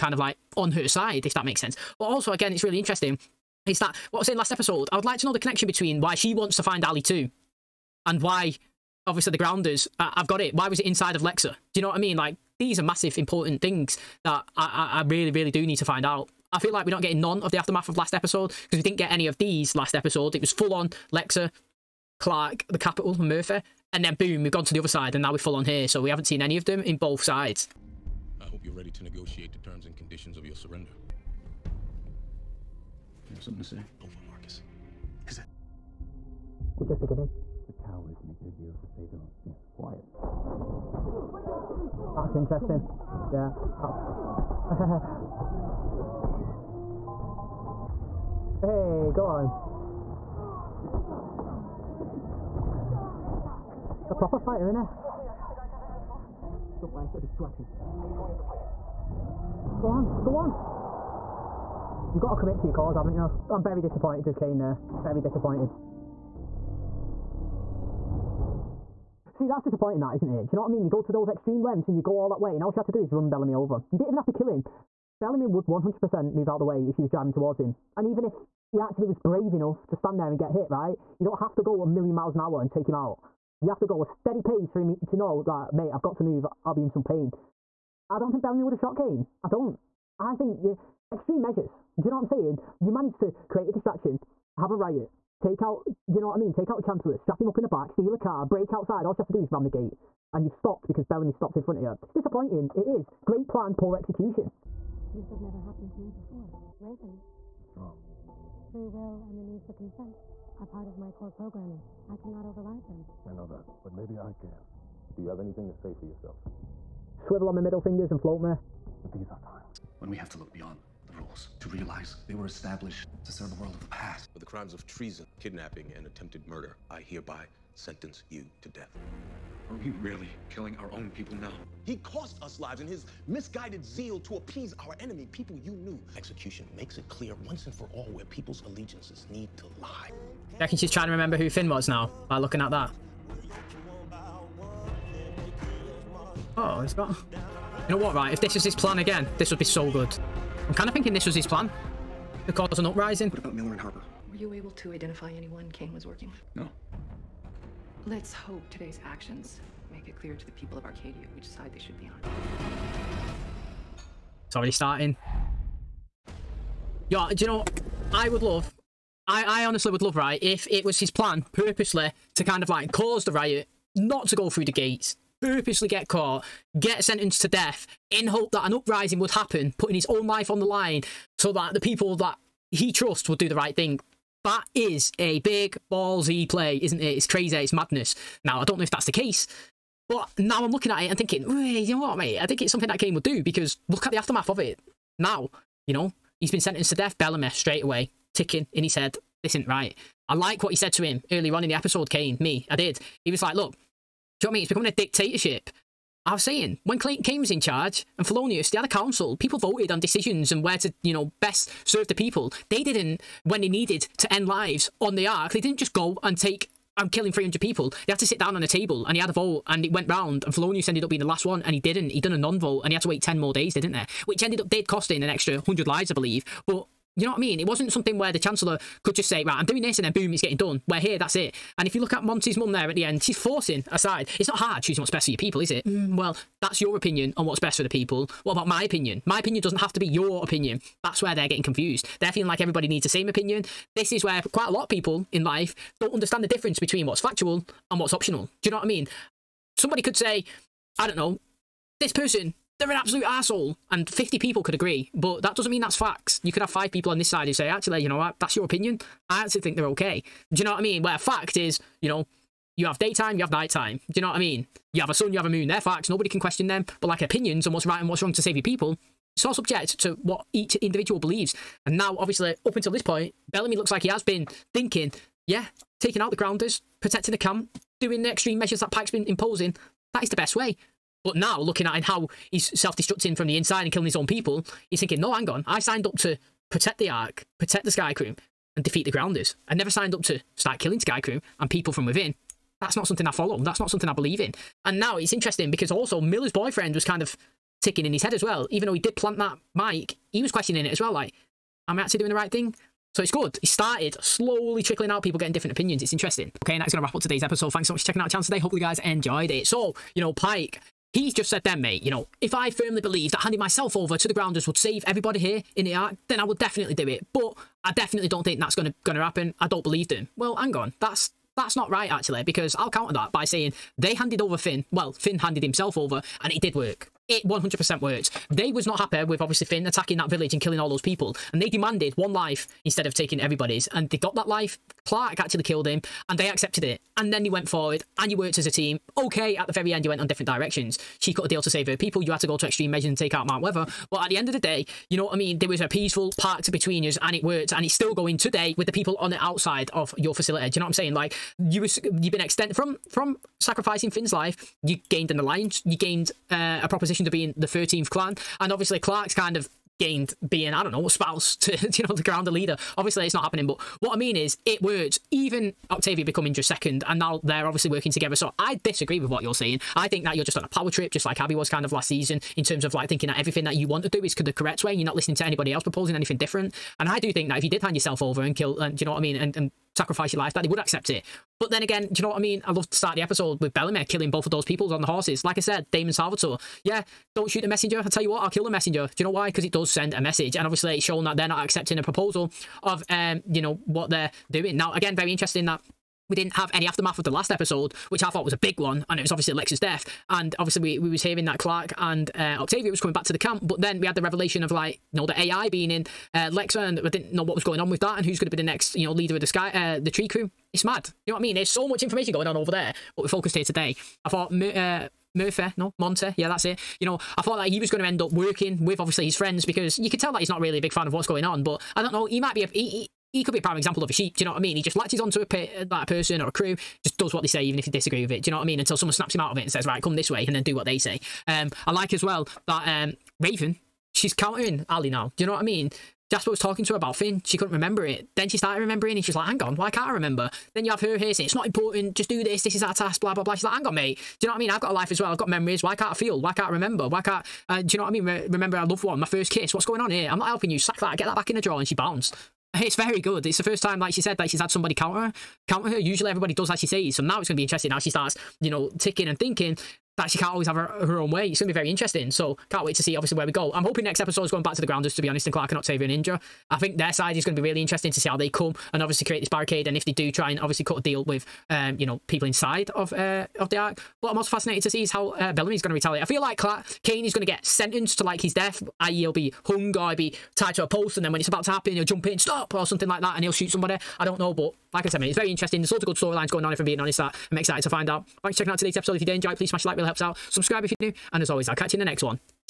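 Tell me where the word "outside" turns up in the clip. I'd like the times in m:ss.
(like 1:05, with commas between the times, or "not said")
1:38, 5:49.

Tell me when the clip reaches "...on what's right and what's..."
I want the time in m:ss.
4:27.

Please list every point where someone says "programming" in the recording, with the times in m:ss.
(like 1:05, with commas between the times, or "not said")
1:51.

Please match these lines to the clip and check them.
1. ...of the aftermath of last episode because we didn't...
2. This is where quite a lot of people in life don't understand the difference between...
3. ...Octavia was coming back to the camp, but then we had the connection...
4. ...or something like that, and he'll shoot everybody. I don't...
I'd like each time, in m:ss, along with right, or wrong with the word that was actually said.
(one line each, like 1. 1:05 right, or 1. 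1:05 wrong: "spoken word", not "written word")
1. 0:17 right
2. 4:03 right
3. 6:42 wrong: "revelation", not "connection"
4. 8:02 wrong: "somebody", not "everybody".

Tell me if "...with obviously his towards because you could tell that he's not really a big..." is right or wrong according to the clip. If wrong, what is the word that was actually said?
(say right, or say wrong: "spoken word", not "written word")
wrong: "friends", not "towards".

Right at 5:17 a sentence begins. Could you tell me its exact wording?
But I definitely don't think that's gonna gonna happen.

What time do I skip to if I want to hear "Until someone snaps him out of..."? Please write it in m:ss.
7:08.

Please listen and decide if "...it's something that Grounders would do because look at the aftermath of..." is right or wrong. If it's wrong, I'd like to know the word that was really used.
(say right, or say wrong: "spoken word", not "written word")
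wrong: "Kane", not "Grounders".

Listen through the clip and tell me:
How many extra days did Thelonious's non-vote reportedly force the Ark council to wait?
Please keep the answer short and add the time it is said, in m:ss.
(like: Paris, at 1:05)
10, at 3:43.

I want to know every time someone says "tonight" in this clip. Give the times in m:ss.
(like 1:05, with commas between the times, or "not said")
not said.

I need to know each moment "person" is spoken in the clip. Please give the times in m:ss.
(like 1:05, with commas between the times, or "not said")
4:12, 7:06.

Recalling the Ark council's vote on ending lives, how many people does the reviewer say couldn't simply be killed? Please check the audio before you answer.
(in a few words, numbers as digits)
300.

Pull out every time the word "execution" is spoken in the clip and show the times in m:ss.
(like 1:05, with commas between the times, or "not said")
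1:43, 2:16.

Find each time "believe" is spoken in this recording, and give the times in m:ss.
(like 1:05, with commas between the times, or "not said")
3:46, 4:31, 4:54, 5:12, 5:19.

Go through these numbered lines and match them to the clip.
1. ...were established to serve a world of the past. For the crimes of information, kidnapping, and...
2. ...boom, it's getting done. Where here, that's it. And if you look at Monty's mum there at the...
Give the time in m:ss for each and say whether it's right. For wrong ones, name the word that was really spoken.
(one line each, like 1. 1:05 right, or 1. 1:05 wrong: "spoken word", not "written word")
1. 2:02 wrong: "treason", not "information"
2. 3:50 right.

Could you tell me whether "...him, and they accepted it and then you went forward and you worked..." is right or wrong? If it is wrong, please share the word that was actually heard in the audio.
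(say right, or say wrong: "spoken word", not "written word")
right.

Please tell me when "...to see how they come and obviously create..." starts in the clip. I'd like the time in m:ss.
7:48.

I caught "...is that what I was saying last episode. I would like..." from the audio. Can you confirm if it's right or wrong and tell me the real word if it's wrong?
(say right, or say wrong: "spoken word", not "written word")
right.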